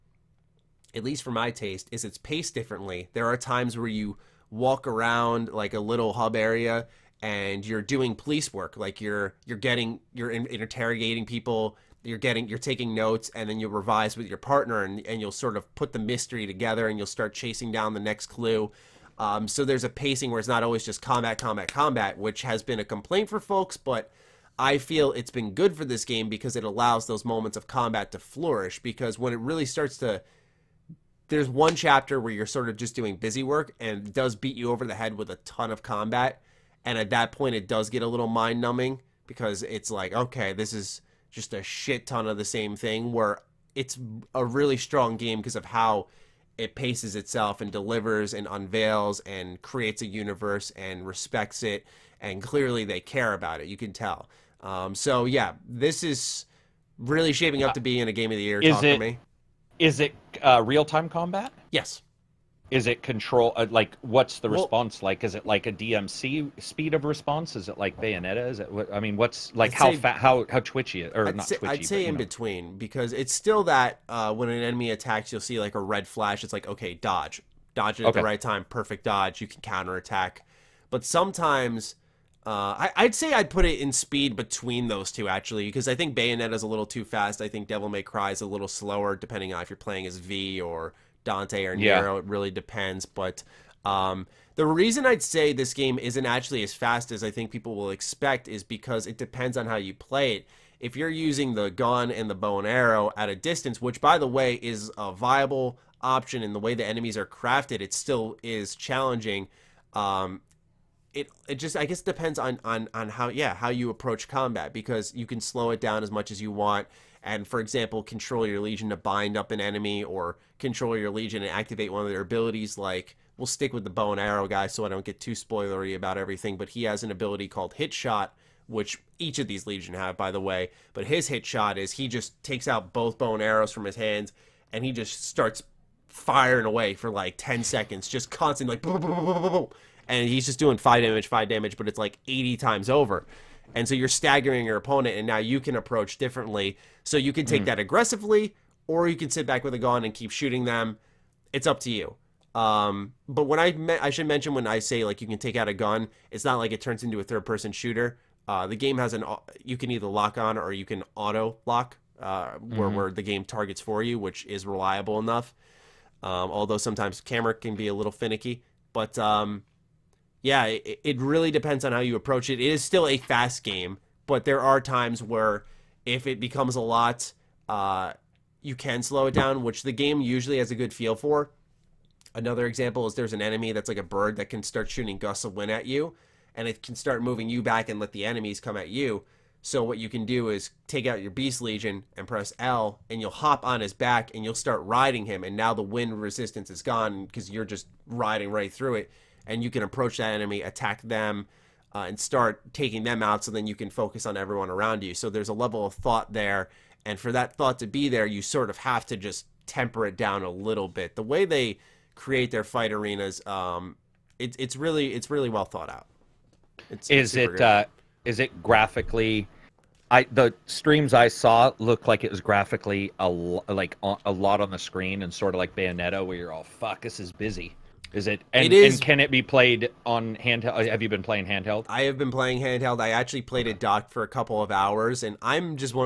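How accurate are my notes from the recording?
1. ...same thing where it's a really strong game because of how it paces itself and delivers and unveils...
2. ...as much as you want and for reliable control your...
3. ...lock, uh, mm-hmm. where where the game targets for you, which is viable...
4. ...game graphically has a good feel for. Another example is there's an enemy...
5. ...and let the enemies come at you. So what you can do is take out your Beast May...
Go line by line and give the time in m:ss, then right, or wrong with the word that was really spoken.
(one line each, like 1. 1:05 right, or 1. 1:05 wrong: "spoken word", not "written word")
1. 0:42 right
2. 1:56 wrong: "example", not "reliable"
3. 2:41 wrong: "reliable", not "viable"
4. 2:59 wrong: "usually", not "graphically"
5. 3:07 wrong: "Legion", not "May".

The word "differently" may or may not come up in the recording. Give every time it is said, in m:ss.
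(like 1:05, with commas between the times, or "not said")
0:02, 2:26.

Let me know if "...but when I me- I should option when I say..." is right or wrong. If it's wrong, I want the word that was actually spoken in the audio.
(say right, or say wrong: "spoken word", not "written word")
wrong: "mention", not "option".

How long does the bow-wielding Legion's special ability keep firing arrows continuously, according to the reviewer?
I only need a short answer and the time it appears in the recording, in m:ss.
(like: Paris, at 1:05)
10 seconds, at 2:17.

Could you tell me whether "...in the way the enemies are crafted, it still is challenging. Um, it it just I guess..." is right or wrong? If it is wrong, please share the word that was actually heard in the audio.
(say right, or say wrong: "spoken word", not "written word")
right.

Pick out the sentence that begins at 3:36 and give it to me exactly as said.
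It's, is it's it uh, is it graphically?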